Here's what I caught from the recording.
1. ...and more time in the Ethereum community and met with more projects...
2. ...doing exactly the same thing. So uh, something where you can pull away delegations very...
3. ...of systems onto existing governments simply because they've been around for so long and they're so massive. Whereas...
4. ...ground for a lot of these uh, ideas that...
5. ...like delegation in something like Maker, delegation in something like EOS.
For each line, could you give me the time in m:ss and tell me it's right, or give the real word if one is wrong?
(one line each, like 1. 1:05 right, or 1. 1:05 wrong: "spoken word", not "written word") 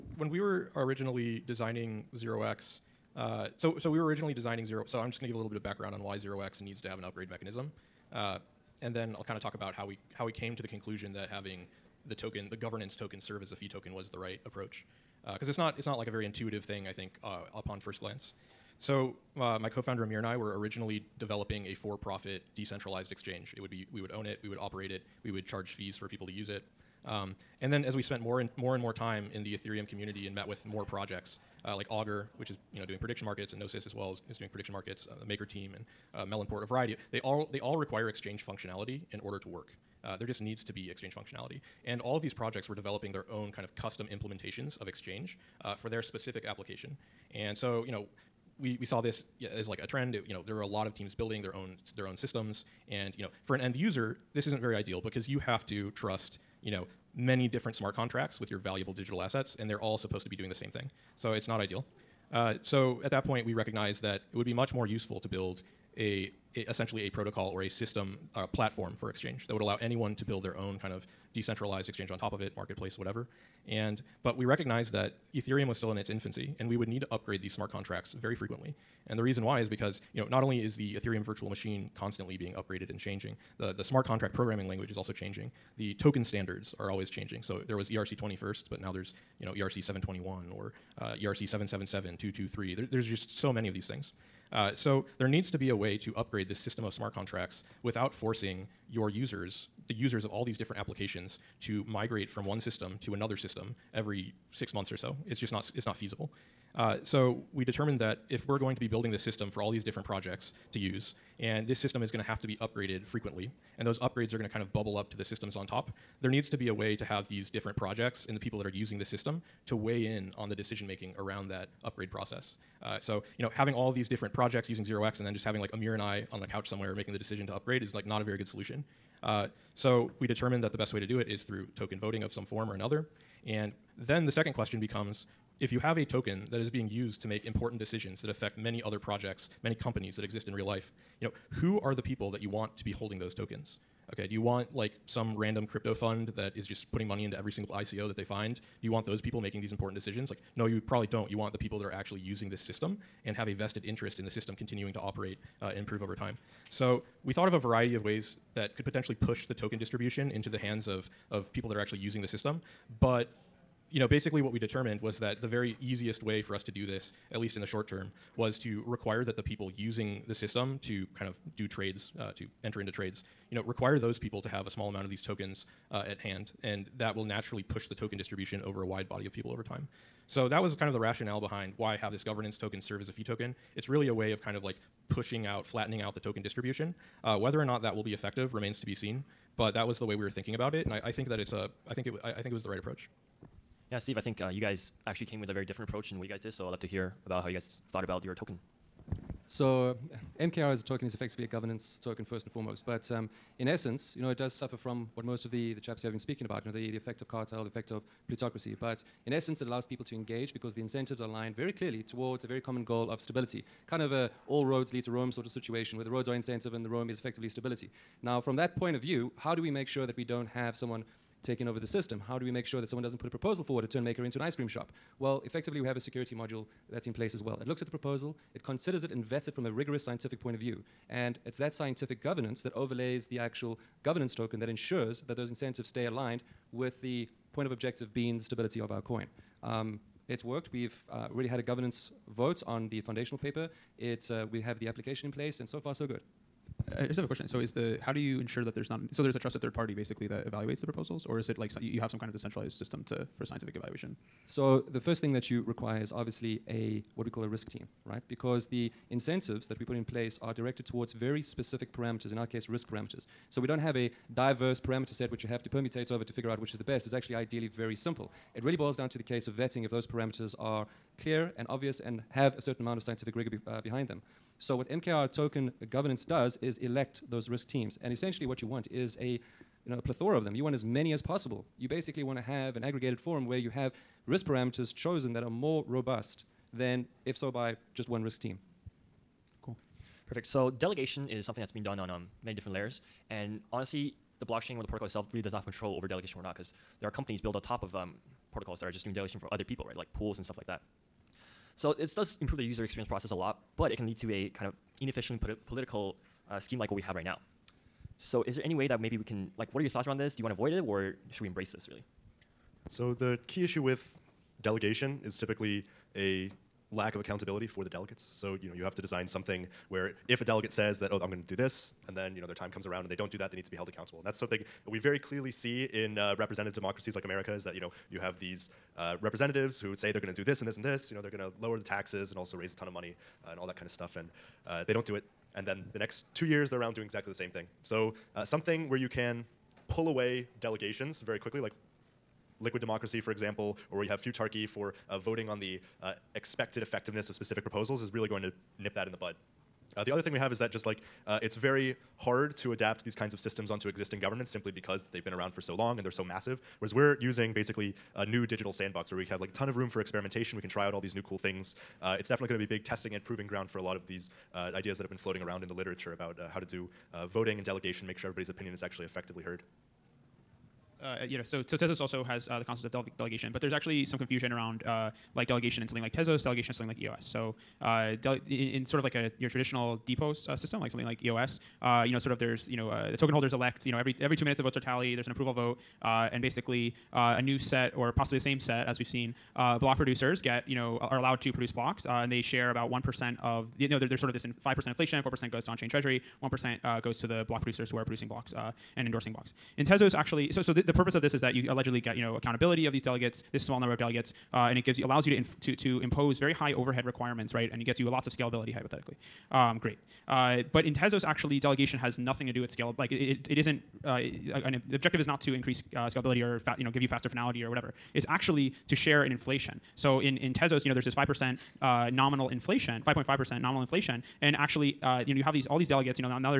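1. 0:28 right
2. 5:36 right
3. 5:53 right
4. 6:03 right
5. 6:15 wrong: "Tezos", not "Maker".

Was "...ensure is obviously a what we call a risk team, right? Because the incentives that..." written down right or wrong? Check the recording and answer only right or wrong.
wrong.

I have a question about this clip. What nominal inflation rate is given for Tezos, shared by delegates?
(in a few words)
5.5%.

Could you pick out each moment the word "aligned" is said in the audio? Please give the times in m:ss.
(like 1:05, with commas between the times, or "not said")
3:31, 3:56.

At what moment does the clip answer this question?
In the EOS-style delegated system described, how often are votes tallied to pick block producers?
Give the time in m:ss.
6:24.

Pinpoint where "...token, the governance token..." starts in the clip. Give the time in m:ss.
0:12.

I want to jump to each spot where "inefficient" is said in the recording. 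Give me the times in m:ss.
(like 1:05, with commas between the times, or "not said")
5:05.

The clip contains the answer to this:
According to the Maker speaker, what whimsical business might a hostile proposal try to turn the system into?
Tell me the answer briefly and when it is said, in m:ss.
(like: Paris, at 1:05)
ice cream shop, at 3:44.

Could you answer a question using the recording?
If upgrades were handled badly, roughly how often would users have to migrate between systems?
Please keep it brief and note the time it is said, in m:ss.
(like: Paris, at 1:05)
every 6 months, at 1:43.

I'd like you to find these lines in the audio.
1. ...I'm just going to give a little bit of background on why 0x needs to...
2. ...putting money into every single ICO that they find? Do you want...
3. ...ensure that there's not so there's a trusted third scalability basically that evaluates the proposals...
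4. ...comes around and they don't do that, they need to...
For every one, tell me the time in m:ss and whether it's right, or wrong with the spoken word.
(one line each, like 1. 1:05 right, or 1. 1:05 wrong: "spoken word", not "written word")
1. 0:04 right
2. 2:26 right
3. 4:08 wrong: "party", not "scalability"
4. 5:22 right.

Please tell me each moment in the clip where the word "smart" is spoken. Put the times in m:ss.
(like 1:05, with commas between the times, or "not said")
0:57, 1:17, 1:23, 1:36.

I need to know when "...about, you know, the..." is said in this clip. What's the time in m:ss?
3:26.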